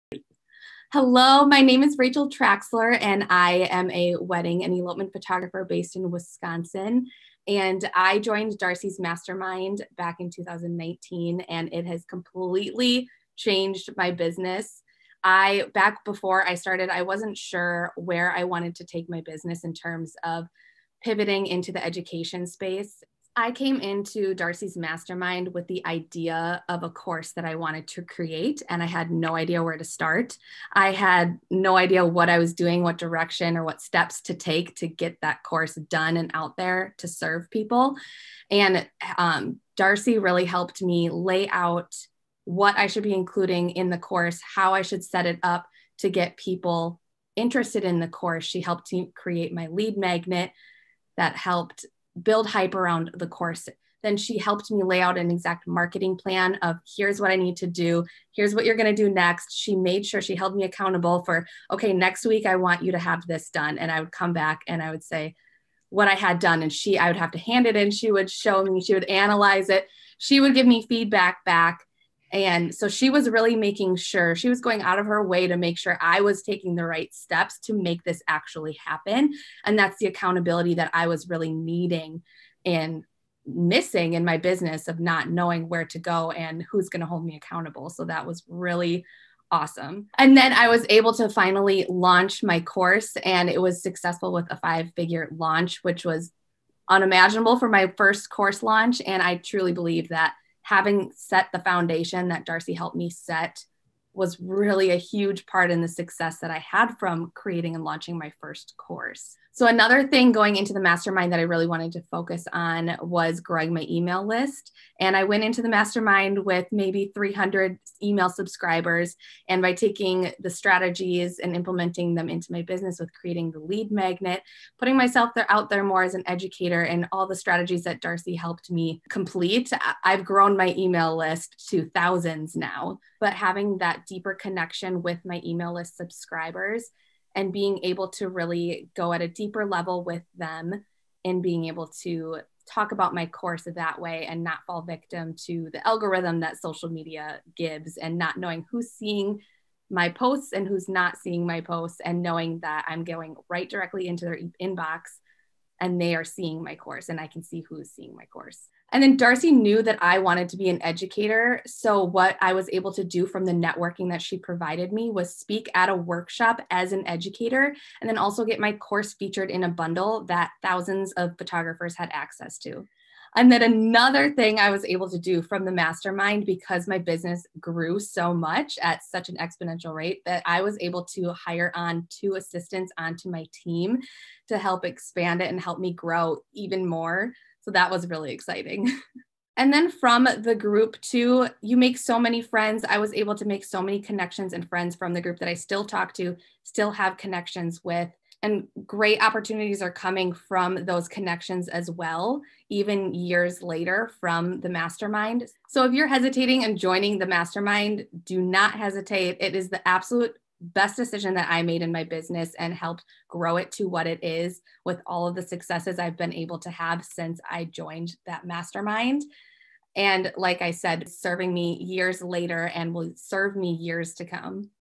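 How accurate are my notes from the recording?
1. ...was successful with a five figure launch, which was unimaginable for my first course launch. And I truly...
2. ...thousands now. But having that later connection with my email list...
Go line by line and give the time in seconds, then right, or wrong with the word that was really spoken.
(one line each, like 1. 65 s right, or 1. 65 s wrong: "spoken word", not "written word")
1. 93 s right
2. 131 s wrong: "deeper", not "later".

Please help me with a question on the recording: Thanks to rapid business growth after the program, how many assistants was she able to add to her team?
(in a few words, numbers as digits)
2.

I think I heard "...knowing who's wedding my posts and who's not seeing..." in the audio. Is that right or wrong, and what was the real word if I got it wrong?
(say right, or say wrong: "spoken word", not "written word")
wrong: "seeing", not "wedding".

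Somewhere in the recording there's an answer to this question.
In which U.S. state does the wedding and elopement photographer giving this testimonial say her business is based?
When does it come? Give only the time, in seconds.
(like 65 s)
6 s.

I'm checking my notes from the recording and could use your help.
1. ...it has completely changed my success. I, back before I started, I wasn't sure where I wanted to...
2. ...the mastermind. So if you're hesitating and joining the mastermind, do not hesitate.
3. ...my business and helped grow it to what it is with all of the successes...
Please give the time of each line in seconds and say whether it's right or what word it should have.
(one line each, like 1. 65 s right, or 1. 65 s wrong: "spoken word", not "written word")
1. 11 s wrong: "business", not "success"
2. 204 s right
3. 211 s right.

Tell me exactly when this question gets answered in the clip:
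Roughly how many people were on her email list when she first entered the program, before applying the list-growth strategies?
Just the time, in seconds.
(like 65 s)
117 s.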